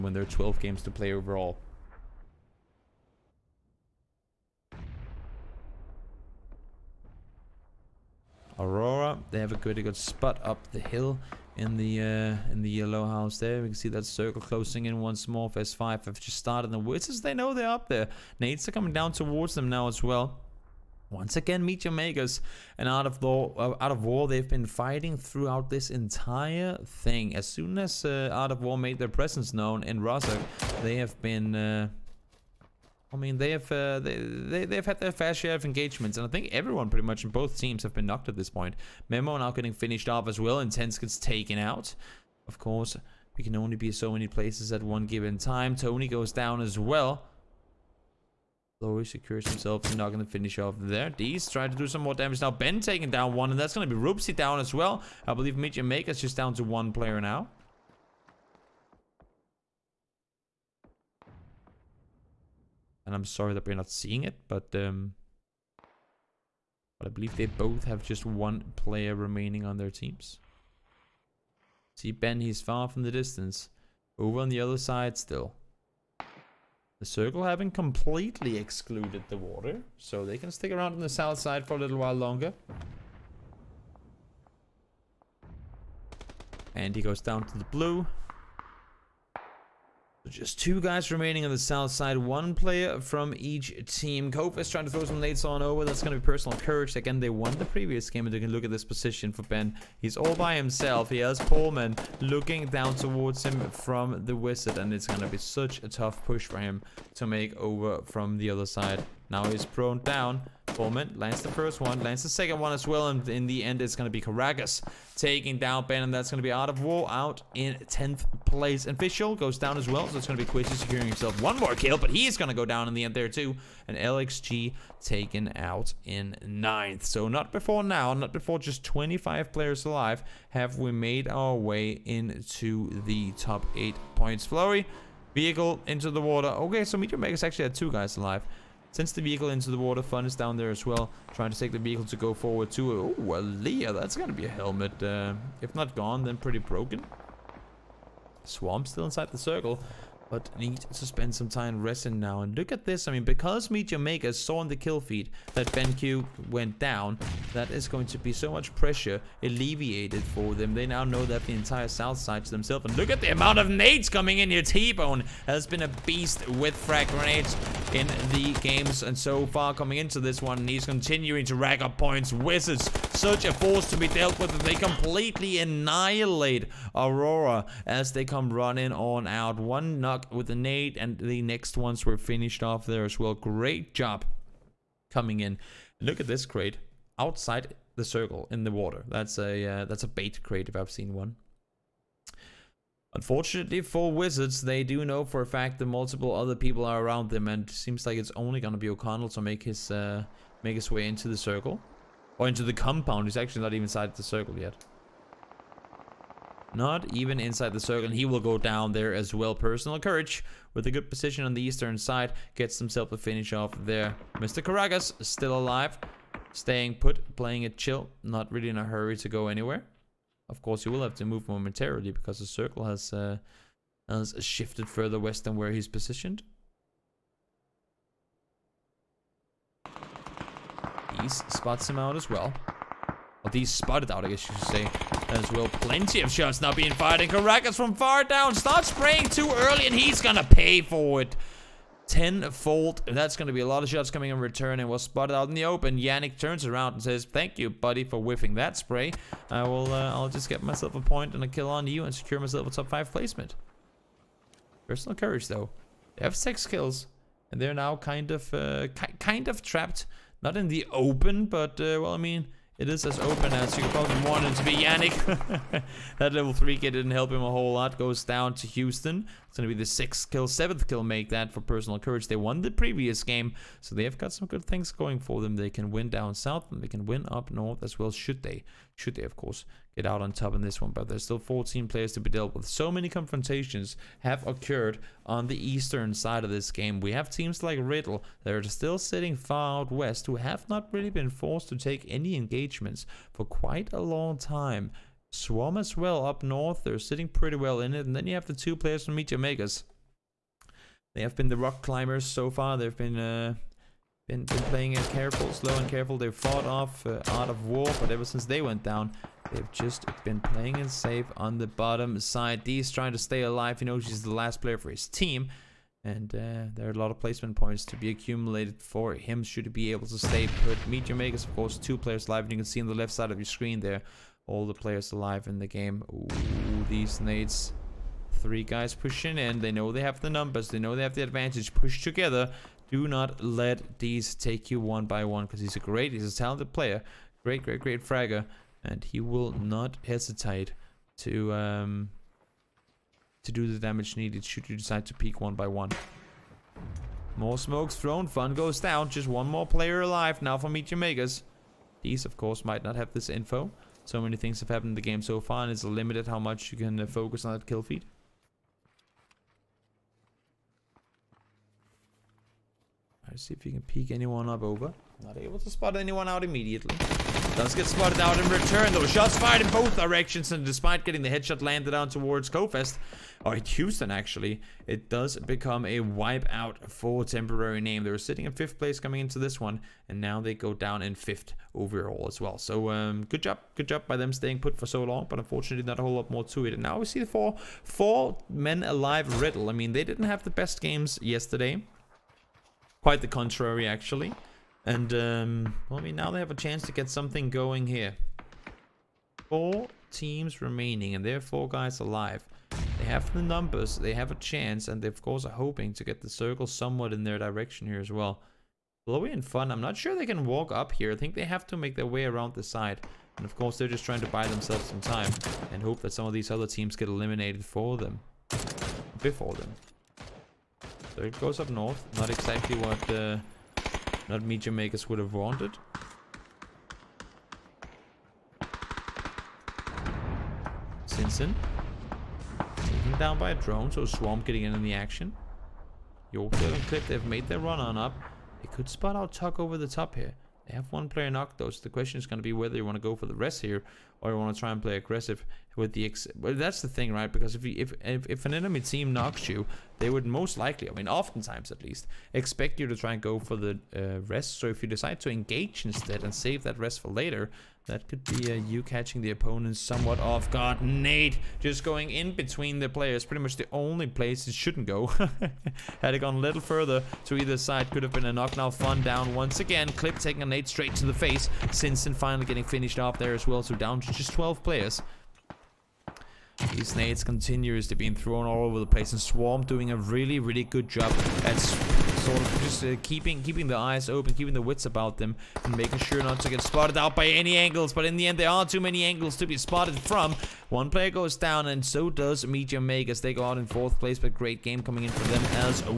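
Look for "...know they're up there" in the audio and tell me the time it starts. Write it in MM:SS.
00:17.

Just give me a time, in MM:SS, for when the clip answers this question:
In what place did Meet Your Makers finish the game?
08:13.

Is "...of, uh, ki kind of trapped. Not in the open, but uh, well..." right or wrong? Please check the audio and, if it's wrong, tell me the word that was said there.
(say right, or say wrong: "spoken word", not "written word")
right.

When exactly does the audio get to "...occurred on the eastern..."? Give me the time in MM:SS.
04:44.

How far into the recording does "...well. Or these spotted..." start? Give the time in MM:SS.
03:52.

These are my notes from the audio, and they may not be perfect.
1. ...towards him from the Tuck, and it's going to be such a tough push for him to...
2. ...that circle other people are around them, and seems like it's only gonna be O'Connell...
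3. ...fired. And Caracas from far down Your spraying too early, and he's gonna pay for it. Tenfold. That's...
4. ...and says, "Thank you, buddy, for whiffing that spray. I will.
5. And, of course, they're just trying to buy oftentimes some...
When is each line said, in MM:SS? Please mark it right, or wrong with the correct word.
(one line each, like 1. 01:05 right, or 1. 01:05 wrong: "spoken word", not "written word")
1. 01:42 wrong: "Wizard", not "Tuck"
2. 03:15 wrong: "multiple", not "circle"
3. 03:56 wrong: "Stop", not "Your"
4. 04:06 right
5. 06:53 wrong: "themselves", not "oftentimes".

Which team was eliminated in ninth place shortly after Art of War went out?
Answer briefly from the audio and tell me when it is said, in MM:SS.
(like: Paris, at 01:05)
LXG, at 02:03.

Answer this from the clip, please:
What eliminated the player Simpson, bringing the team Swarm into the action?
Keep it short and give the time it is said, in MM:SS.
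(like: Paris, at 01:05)
A drone, at 07:13.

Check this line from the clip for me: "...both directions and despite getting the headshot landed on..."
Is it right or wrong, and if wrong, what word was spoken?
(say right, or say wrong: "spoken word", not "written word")
right.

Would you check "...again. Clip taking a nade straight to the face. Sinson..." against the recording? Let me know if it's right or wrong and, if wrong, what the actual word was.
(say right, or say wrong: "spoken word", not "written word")
right.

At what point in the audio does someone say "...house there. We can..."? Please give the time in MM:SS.
00:13.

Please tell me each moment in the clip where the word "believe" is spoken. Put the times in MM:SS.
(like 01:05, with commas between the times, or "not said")
00:55, 01:07.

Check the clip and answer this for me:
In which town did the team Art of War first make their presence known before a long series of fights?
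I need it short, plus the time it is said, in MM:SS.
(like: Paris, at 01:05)
Rozhok, at 00:30.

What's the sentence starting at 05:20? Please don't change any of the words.
Meet Makers, of course, two players live.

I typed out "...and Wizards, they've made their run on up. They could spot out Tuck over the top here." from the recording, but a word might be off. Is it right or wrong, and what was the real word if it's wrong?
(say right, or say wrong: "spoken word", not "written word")
wrong: "Clip", not "Wizards".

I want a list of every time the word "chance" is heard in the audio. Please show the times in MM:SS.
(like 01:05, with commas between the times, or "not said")
06:36, 06:44.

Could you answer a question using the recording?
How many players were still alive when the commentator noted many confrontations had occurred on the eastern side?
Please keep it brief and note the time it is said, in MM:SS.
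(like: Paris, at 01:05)
14, at 04:41.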